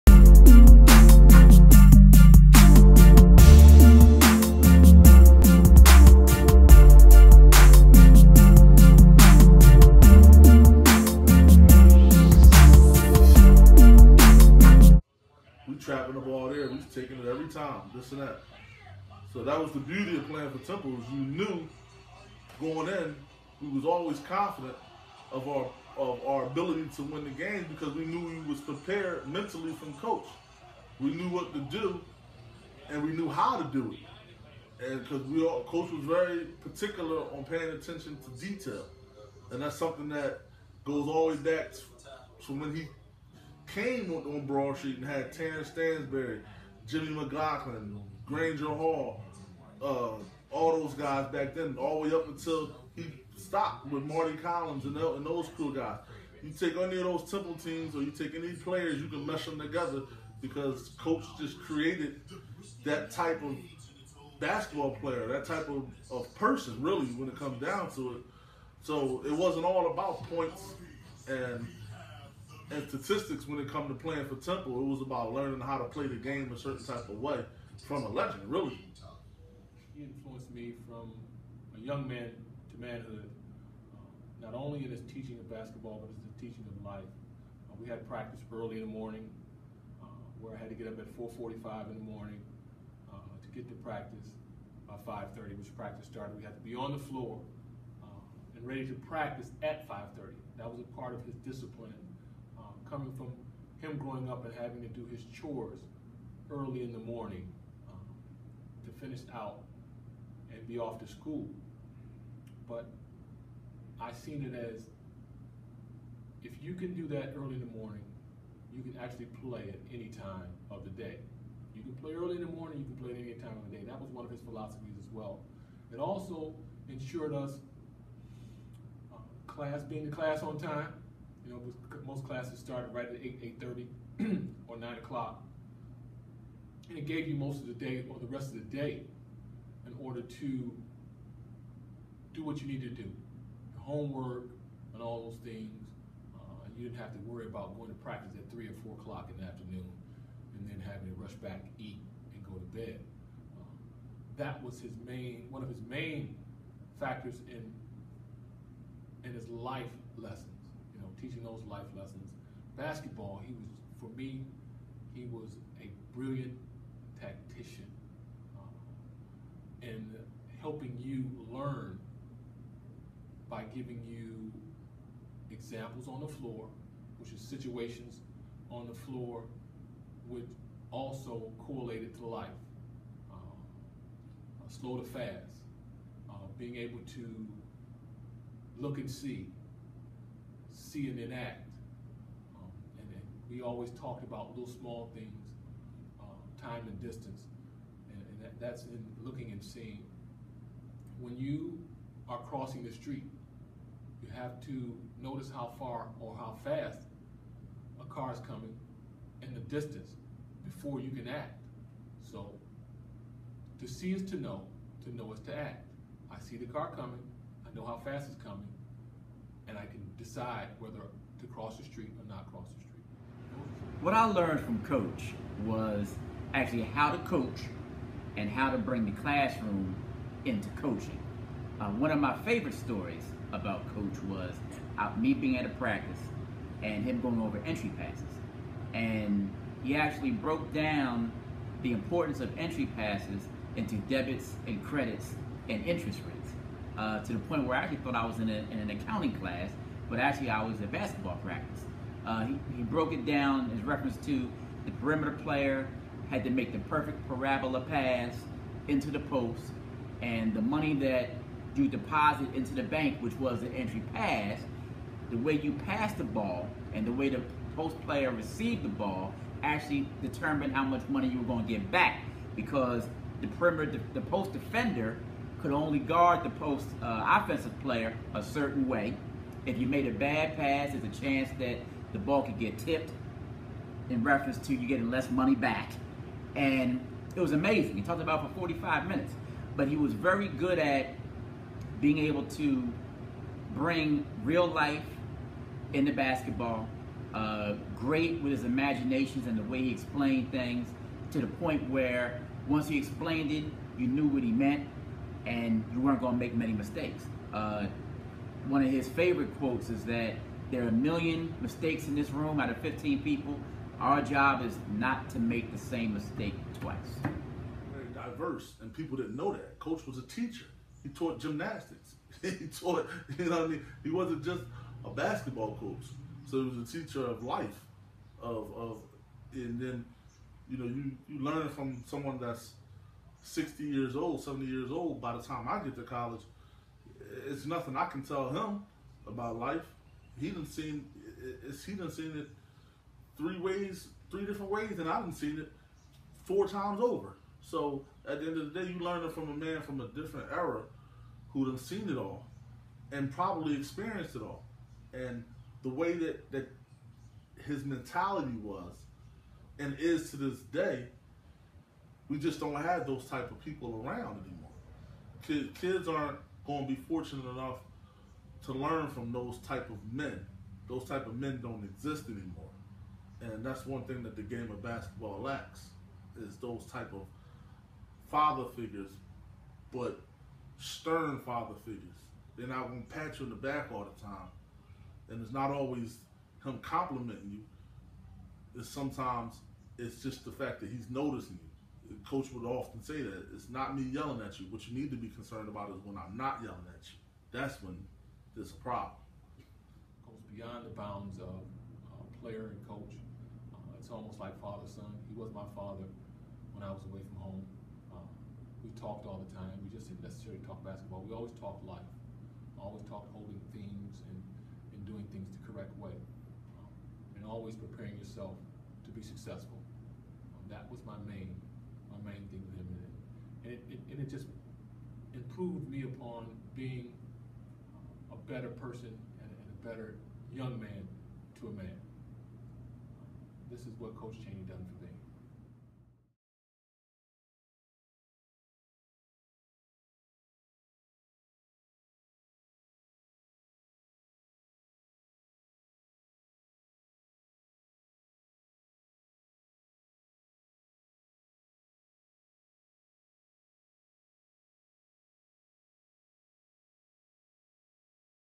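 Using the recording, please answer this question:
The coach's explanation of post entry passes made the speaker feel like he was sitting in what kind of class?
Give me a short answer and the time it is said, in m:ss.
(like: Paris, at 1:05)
accounting, at 4:08.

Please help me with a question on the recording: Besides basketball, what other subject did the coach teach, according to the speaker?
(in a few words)
gymnastics.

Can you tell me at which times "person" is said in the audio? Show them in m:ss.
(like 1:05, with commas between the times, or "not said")
1:06, 7:08.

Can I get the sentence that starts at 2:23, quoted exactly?
Your homework and all those things.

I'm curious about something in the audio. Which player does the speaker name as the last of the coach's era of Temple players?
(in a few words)
Mardy Collins.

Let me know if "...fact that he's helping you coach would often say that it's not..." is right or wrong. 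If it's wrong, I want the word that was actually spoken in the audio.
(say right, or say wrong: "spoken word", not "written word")
wrong: "noticing", not "helping".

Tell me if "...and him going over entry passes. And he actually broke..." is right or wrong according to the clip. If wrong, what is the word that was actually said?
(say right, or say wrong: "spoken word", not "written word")
right.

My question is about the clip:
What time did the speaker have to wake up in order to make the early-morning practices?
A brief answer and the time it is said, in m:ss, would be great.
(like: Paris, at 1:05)
4:45, at 1:31.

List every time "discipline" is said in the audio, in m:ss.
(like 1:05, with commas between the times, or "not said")
1:41.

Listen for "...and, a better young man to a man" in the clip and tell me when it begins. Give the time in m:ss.
7:09.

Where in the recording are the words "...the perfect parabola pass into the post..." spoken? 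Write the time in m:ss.
4:16.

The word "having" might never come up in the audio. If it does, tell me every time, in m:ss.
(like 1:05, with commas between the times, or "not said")
1:44, 2:30.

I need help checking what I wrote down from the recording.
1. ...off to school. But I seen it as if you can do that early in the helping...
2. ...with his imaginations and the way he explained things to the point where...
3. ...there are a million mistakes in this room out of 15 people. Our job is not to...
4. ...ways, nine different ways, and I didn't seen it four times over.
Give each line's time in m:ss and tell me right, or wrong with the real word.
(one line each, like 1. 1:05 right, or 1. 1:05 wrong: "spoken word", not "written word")
1. 1:50 wrong: "morning", not "helping"
2. 4:58 right
3. 5:10 right
4. 5:43 wrong: "three", not "nine".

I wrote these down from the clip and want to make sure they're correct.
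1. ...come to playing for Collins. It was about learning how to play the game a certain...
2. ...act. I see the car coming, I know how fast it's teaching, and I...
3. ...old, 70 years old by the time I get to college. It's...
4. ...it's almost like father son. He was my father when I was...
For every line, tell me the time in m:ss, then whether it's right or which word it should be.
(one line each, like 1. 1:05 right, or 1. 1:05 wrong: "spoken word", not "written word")
1. 1:13 wrong: "Temple", not "Collins"
2. 3:35 wrong: "coming", not "teaching"
3. 5:34 right
4. 6:43 right.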